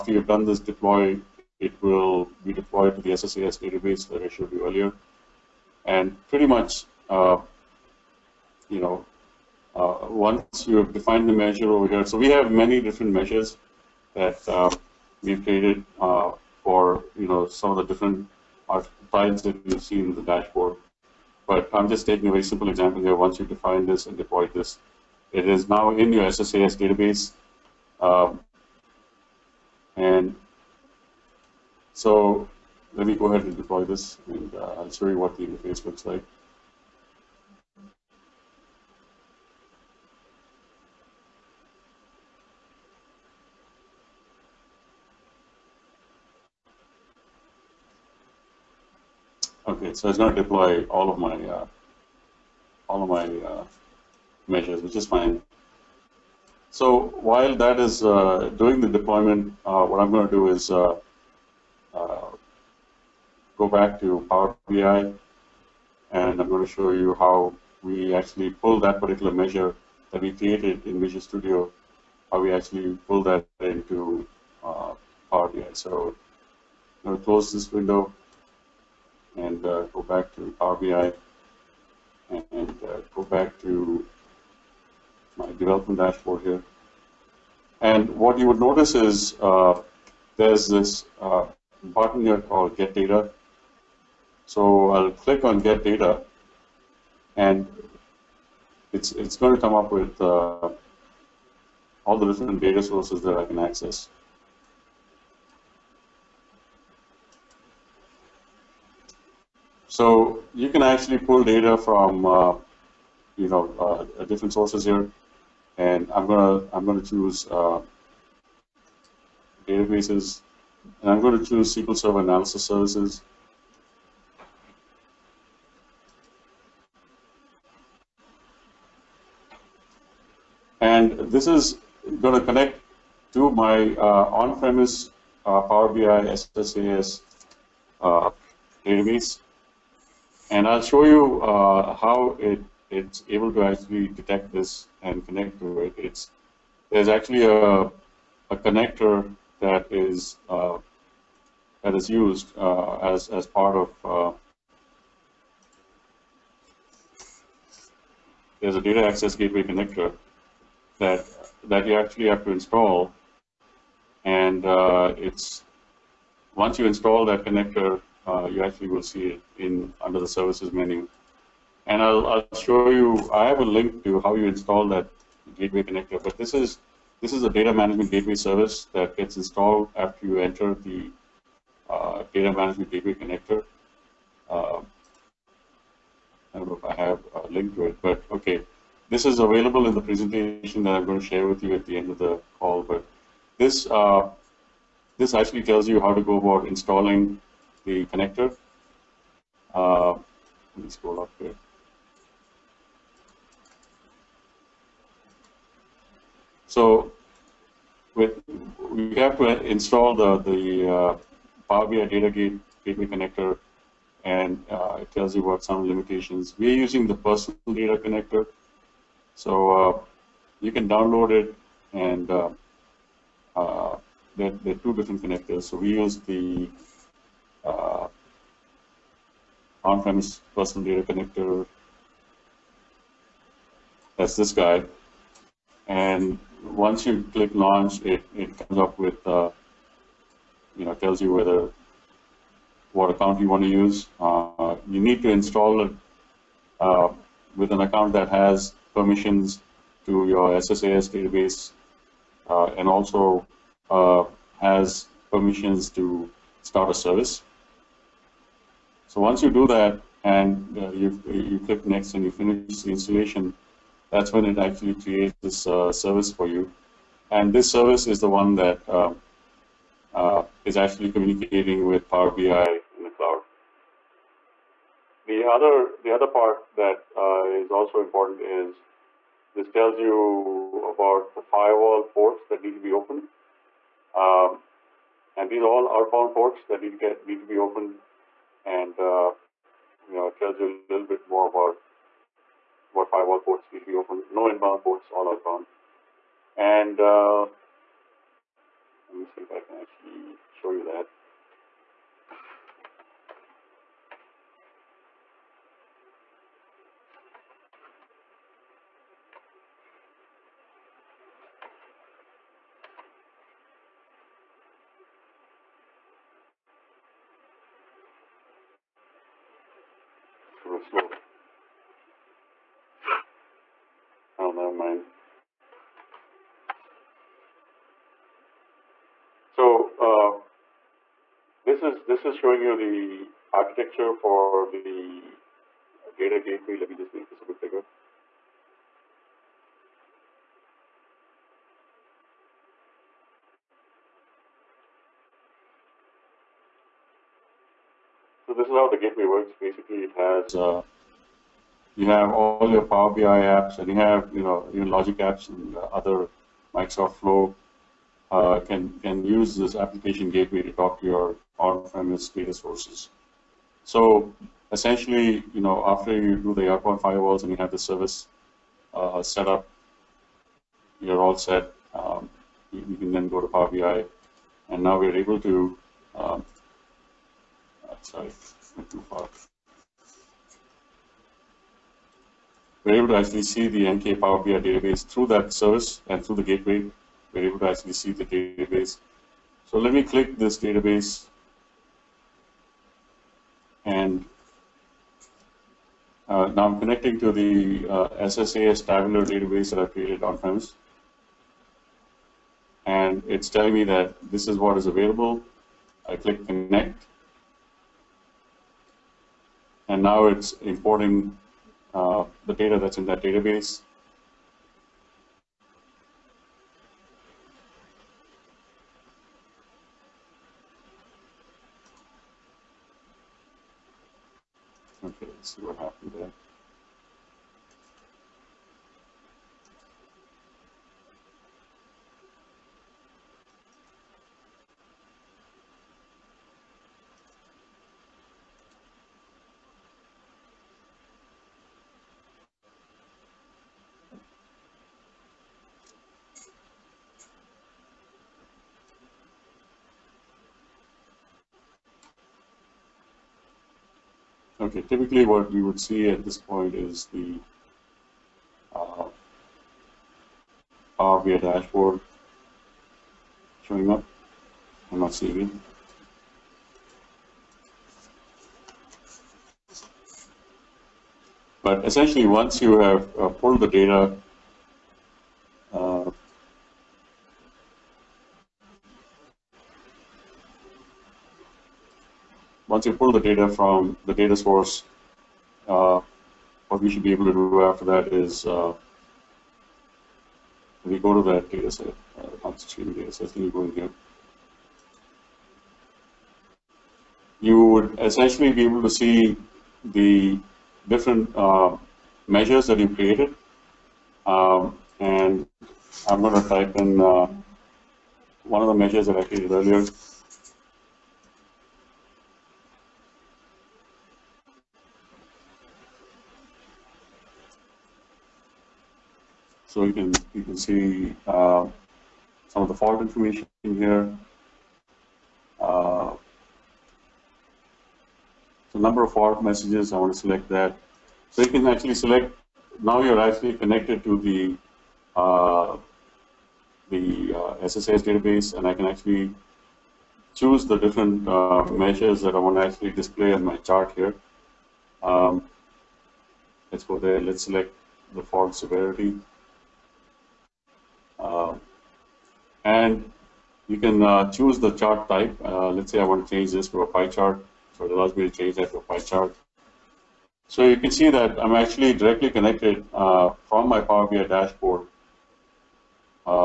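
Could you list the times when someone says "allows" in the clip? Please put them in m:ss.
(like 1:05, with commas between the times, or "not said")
9:17.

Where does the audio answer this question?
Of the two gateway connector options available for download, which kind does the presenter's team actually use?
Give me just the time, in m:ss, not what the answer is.
3:49.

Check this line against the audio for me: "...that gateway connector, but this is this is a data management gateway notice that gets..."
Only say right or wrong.
wrong.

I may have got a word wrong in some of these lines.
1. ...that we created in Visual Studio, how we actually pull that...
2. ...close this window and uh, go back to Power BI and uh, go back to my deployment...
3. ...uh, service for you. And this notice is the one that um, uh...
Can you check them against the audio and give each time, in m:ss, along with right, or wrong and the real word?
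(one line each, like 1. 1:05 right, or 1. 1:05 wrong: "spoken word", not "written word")
1. 1:10 right
2. 1:17 wrong: "development", not "deployment"
3. 4:25 wrong: "service", not "notice".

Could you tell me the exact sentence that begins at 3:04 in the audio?
Uh, I don't know if I have a link to it, but okay.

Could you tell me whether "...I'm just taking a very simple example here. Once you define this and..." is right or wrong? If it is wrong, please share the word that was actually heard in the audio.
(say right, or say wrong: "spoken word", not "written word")
right.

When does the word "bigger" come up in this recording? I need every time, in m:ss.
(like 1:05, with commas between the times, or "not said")
5:37.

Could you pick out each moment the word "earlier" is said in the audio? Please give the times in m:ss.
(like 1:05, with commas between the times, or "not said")
0:04, 8:29.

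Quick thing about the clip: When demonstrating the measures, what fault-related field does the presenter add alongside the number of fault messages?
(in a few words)
Fault severity.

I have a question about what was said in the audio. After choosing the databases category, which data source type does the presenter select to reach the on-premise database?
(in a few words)
SQL Server Analysis Services.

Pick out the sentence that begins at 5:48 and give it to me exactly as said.
So this is how the gateway works.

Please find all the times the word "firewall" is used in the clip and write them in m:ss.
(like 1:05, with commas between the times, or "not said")
4:41, 4:53, 6:07.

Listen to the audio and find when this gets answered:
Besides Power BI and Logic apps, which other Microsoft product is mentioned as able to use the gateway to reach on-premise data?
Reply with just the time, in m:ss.
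5:56.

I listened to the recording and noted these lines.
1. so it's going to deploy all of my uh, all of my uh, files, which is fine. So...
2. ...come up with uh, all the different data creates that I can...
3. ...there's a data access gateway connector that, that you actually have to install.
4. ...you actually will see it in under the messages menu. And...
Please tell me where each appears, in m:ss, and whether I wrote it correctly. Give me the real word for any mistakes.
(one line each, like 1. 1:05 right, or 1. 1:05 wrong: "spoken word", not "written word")
1. 0:49 wrong: "measures", not "files"
2. 1:39 wrong: "sources", not "creates"
3. 2:38 right
4. 2:48 wrong: "services", not "messages".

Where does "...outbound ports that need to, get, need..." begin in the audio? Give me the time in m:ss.
4:45.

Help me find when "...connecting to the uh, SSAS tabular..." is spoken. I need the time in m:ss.
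6:36.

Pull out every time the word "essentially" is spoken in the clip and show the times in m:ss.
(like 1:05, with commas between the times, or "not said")
6:04, 7:51, 8:17.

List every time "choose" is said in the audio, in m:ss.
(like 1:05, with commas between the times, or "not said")
1:57, 2:01, 9:00, 9:14.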